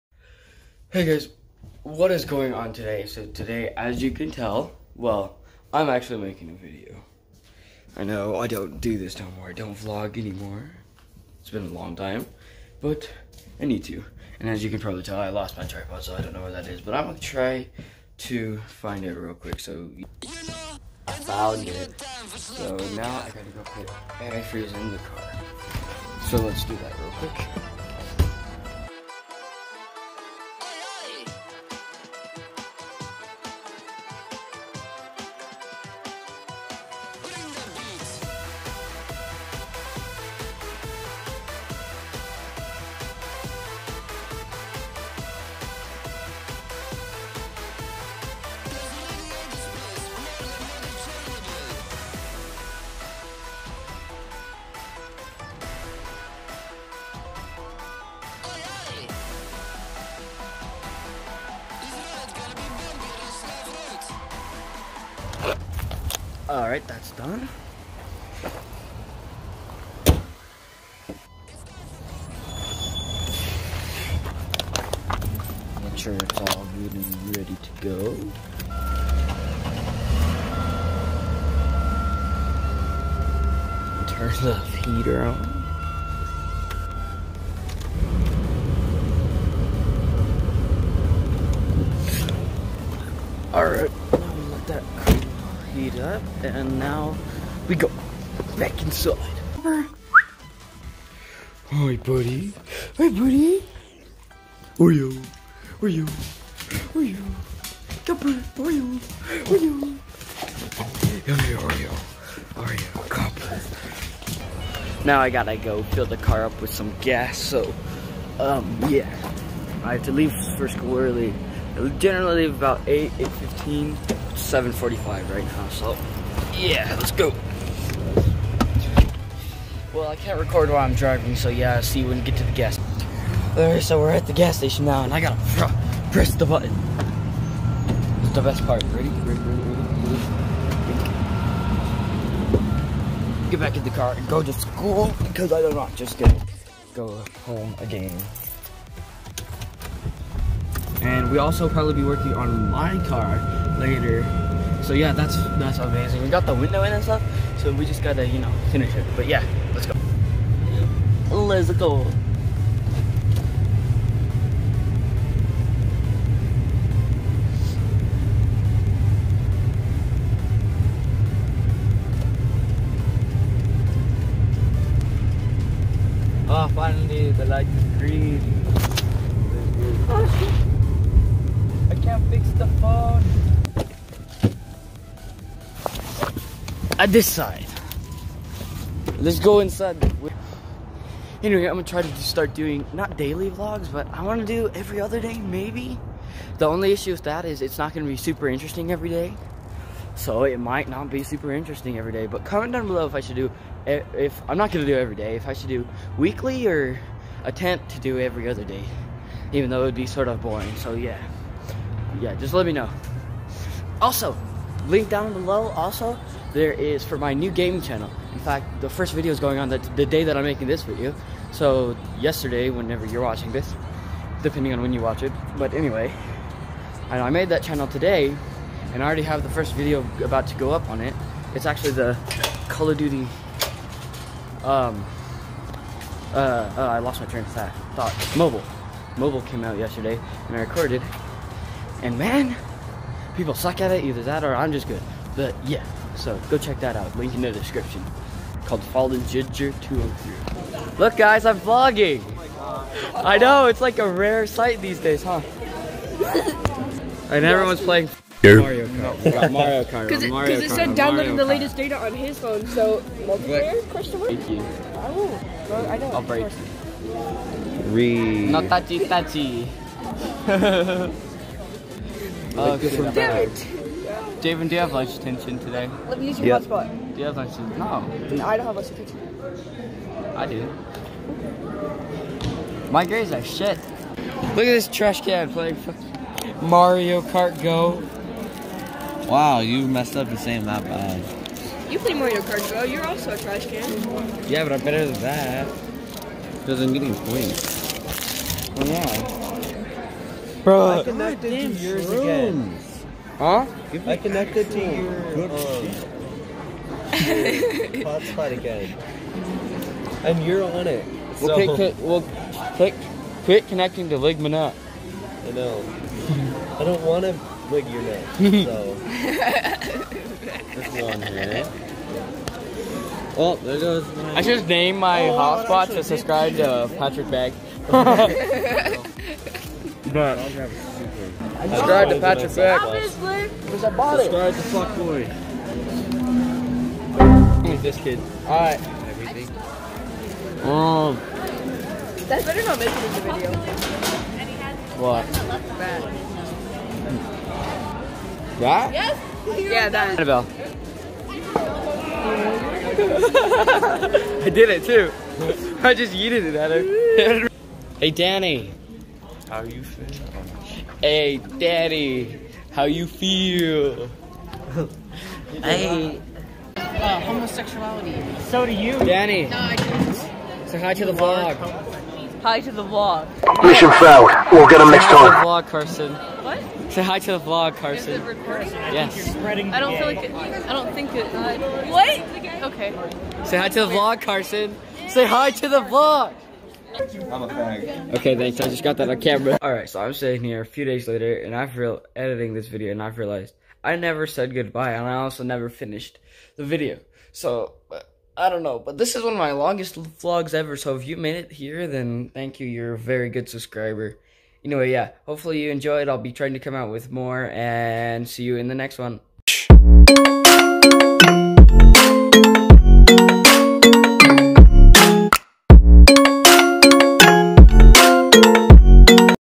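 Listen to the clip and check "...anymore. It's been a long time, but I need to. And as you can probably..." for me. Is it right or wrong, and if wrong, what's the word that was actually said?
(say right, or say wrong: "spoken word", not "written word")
right.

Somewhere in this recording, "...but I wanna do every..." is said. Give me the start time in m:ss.
3:13.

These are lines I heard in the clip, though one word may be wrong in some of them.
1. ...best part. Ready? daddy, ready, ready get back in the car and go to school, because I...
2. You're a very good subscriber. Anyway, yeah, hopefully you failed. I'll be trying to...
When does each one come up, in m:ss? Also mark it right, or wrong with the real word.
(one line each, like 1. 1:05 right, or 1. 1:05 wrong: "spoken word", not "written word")
1. 2:18 wrong: "ready", not "daddy"
2. 6:42 wrong: "enjoyed", not "failed".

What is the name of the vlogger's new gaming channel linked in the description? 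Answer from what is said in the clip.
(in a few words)
Fallen Ginger 203.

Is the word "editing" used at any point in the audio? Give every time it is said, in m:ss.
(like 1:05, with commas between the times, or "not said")
6:32.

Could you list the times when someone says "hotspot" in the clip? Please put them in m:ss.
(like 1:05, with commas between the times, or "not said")
4:36, 5:08, 5:25.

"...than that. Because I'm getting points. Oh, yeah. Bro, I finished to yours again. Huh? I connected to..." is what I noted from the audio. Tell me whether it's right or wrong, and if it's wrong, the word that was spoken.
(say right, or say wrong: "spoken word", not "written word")
wrong: "connected", not "finished".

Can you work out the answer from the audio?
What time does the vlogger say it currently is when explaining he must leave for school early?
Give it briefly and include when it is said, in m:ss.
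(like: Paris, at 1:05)
7:45, at 2:04.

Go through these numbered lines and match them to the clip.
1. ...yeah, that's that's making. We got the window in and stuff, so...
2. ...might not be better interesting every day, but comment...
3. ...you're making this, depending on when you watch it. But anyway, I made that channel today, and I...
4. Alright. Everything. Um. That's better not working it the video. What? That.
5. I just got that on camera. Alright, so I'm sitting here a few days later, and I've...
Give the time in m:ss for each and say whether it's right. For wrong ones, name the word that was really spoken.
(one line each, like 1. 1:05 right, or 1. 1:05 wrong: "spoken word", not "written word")
1. 2:34 wrong: "amazing", not "making"
2. 3:20 wrong: "super", not "better"
3. 3:43 wrong: "watching", not "making"
4. 5:38 wrong: "making", not "working"
5. 6:28 right.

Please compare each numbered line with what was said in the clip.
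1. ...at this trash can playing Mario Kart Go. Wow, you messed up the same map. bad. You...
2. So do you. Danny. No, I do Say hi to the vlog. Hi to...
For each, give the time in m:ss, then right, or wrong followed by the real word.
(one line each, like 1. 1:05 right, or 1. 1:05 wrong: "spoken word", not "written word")
1. 4:44 right
2. 6:08 right.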